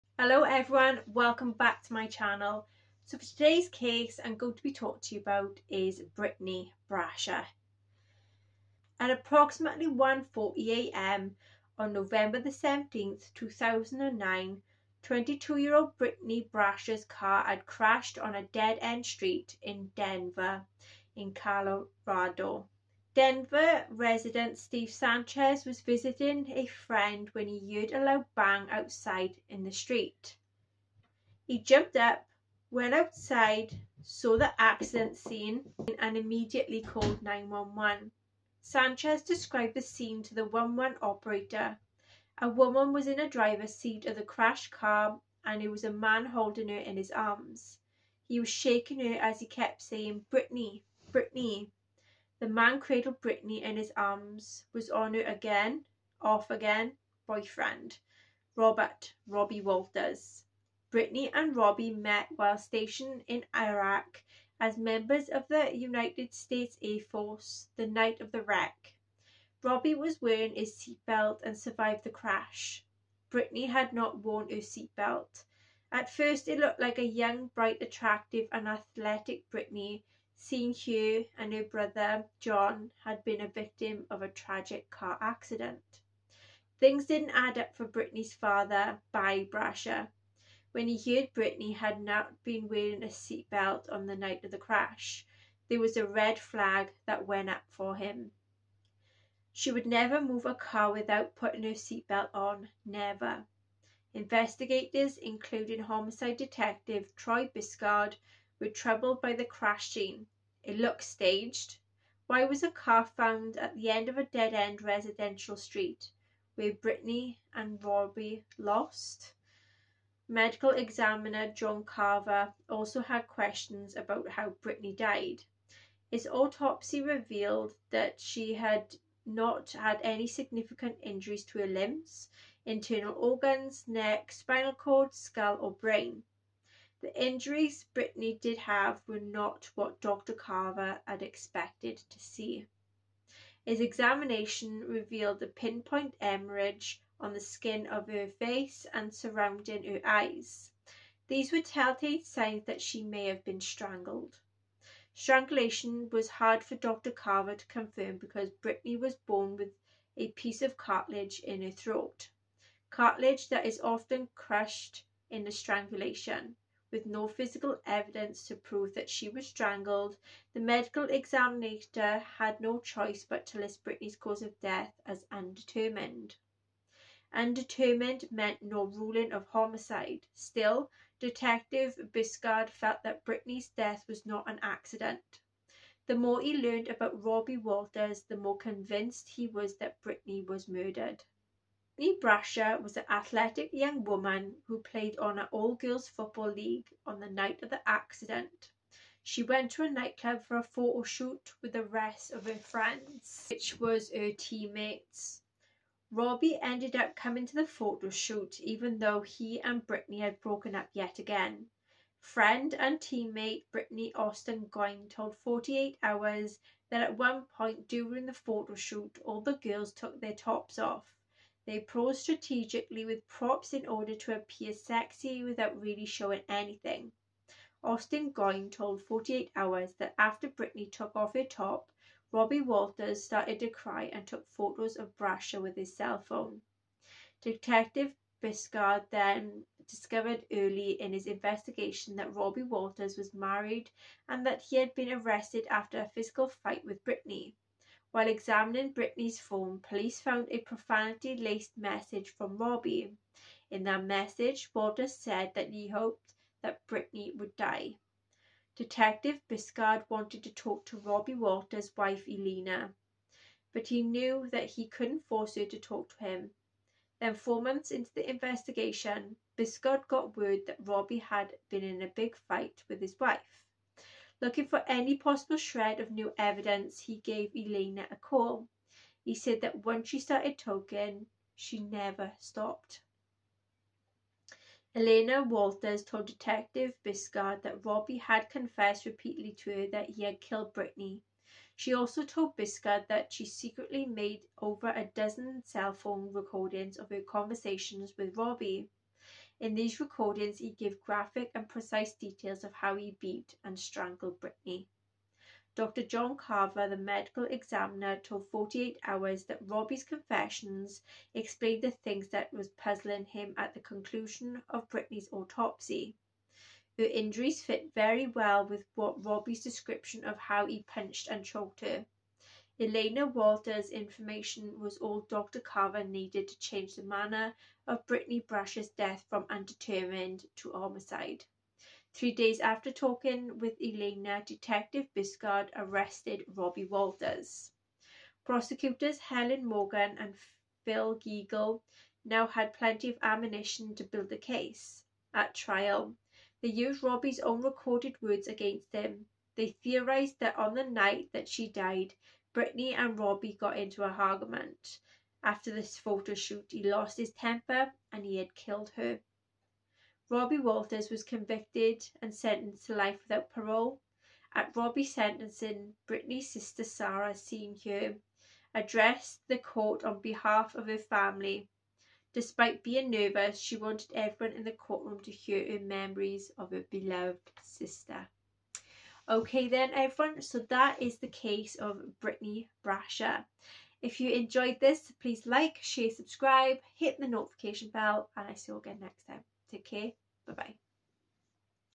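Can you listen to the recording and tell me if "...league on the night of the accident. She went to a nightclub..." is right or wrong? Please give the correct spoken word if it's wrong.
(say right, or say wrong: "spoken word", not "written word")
right.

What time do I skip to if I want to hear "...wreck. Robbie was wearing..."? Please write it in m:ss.
1:08.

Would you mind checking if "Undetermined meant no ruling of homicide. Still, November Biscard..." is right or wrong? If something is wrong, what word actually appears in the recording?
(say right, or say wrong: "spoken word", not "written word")
wrong: "Detective", not "November".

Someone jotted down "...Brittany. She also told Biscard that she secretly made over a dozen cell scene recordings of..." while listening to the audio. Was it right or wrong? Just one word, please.
wrong.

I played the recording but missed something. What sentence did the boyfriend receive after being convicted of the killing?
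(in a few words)
life without parole.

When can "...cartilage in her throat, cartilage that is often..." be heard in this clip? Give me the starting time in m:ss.
2:40.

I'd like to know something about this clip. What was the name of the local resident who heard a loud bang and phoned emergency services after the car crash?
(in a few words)
Steve Sanchez.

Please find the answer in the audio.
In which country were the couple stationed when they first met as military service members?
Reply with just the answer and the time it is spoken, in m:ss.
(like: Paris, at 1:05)
Iraq, at 1:03.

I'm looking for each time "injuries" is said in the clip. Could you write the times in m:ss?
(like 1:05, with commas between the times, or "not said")
2:11, 2:17, 5:17.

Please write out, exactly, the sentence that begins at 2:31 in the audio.
These were telltale signs that she may have been strangled.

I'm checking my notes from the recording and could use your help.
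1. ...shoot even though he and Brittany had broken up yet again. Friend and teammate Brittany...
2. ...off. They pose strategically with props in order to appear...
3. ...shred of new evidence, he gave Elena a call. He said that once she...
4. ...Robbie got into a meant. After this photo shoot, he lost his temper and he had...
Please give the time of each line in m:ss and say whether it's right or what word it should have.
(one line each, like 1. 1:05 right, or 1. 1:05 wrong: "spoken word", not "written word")
1. 3:28 right
2. 3:40 right
3. 4:35 right
4. 5:53 wrong: "argument", not "meant".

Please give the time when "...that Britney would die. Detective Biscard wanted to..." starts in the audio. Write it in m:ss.
4:16.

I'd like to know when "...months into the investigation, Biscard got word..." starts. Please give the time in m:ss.
4:27.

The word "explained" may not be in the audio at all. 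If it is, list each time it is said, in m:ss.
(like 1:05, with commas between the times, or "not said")
5:11.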